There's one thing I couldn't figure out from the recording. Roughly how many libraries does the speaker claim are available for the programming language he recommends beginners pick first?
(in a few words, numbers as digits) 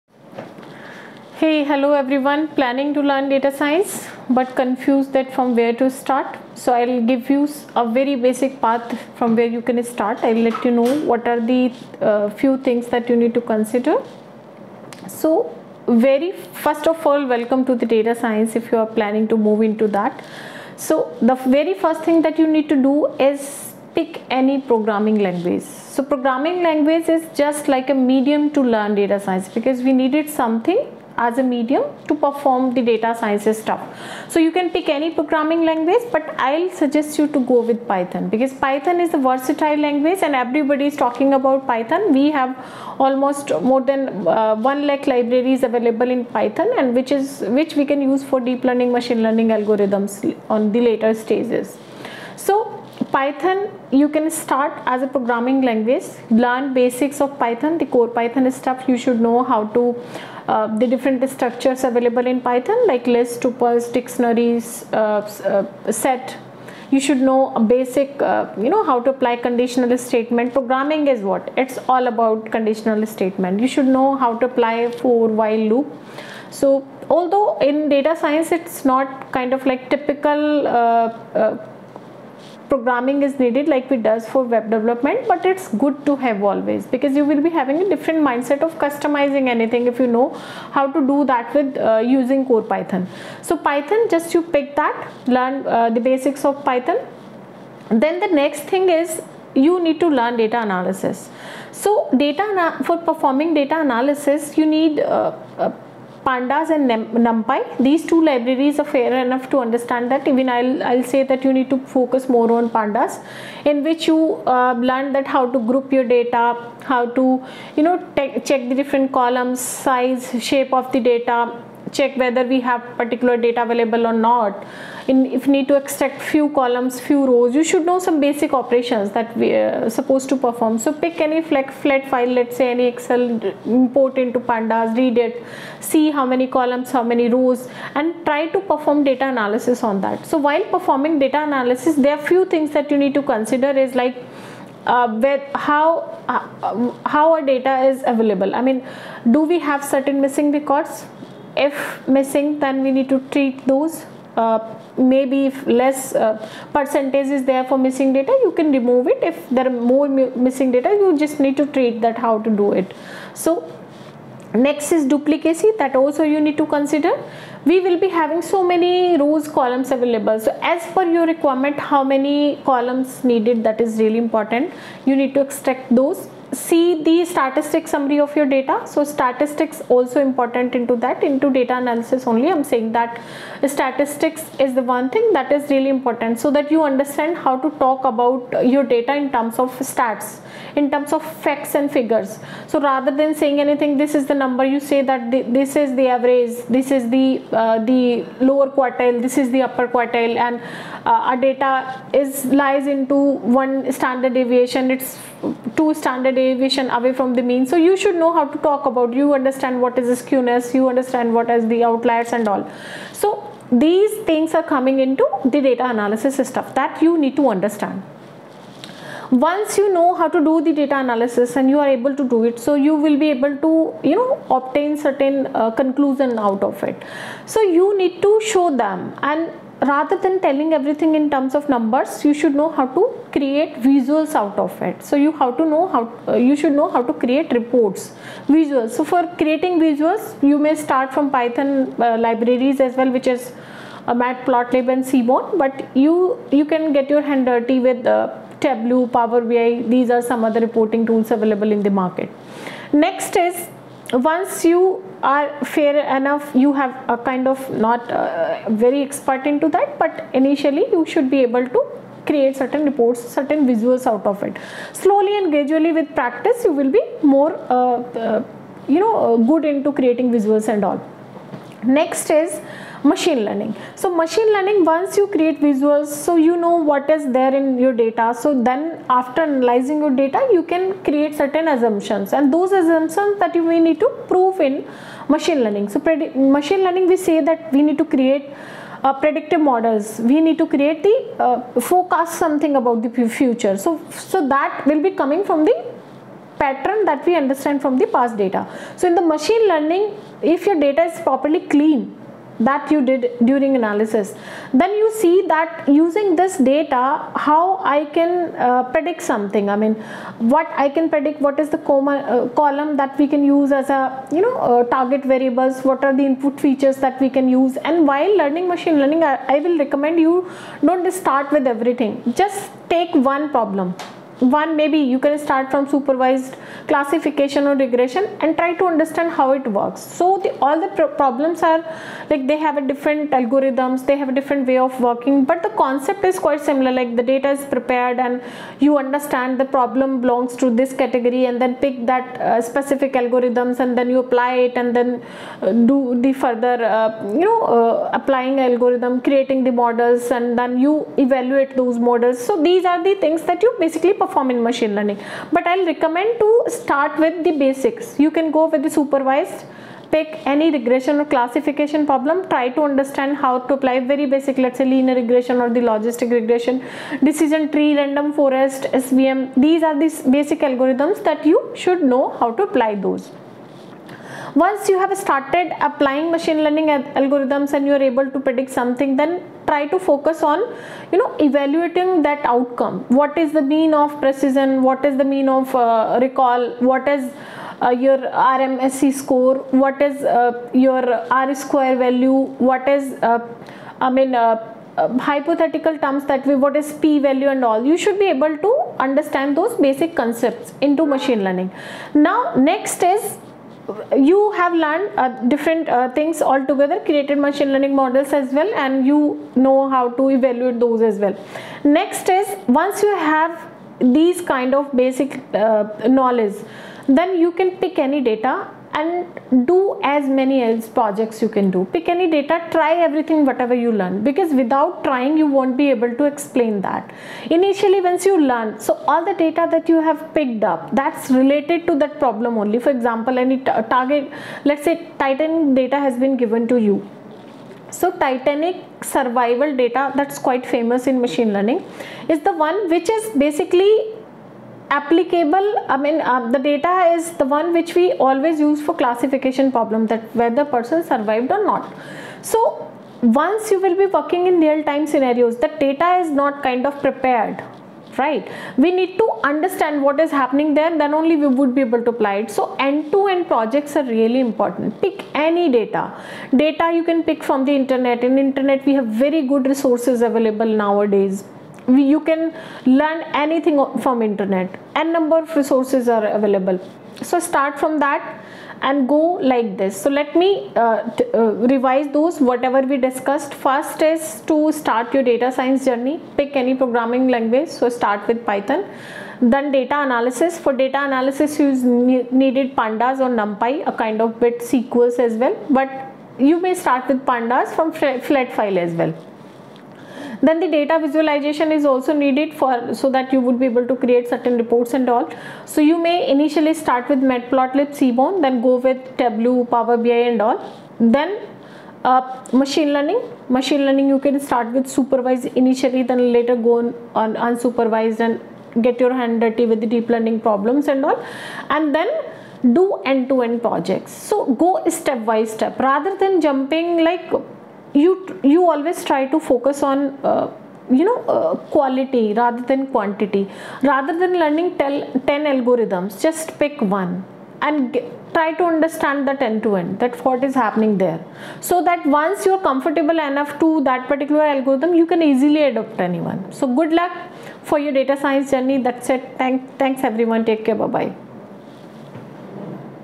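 1 lakh.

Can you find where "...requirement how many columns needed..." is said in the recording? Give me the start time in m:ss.
2:51.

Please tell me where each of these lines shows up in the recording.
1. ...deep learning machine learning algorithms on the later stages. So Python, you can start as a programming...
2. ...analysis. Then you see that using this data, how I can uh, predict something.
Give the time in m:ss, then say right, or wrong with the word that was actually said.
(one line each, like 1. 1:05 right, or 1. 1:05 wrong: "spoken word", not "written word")
1. 0:48 right
2. 5:03 right.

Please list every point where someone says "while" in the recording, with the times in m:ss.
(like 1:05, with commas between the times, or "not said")
1:15, 2:20, 5:18.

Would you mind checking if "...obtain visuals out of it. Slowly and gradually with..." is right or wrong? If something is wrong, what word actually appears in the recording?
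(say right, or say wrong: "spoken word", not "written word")
wrong: "certain", not "obtain".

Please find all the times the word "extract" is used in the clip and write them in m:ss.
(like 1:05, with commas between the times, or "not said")
2:05, 2:55.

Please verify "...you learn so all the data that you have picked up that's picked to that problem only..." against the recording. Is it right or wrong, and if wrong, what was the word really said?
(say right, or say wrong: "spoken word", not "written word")
wrong: "related", not "picked".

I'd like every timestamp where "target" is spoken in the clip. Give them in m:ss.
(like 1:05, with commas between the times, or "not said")
5:14, 7:13.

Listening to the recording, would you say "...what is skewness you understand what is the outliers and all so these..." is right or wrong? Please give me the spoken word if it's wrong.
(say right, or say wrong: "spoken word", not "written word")
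right.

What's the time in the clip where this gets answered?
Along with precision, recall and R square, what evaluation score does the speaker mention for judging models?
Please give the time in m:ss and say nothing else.
6:28.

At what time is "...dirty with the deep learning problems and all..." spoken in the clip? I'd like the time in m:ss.
8:39.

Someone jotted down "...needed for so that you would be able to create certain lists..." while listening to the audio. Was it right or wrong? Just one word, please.
wrong.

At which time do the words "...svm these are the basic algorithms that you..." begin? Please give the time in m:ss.
6:09.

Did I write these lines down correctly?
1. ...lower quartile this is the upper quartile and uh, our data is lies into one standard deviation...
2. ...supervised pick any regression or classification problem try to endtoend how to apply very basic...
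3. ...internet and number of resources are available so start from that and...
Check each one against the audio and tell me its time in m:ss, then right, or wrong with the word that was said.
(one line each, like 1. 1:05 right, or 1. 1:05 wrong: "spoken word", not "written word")
1. 3:18 right
2. 5:58 wrong: "understand", not "endtoend"
3. 7:54 right.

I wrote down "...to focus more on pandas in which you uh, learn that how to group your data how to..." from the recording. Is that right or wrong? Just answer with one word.
right.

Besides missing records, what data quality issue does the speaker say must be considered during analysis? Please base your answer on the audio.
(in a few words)
duplicacy.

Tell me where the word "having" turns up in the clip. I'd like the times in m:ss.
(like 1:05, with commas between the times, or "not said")
1:27, 2:48.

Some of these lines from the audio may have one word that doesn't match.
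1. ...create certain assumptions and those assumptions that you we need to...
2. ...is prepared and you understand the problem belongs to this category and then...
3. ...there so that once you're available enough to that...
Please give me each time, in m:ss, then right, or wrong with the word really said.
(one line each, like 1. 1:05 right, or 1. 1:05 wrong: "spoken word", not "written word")
1. 4:41 right
2. 5:37 right
3. 9:00 wrong: "comfortable", not "available".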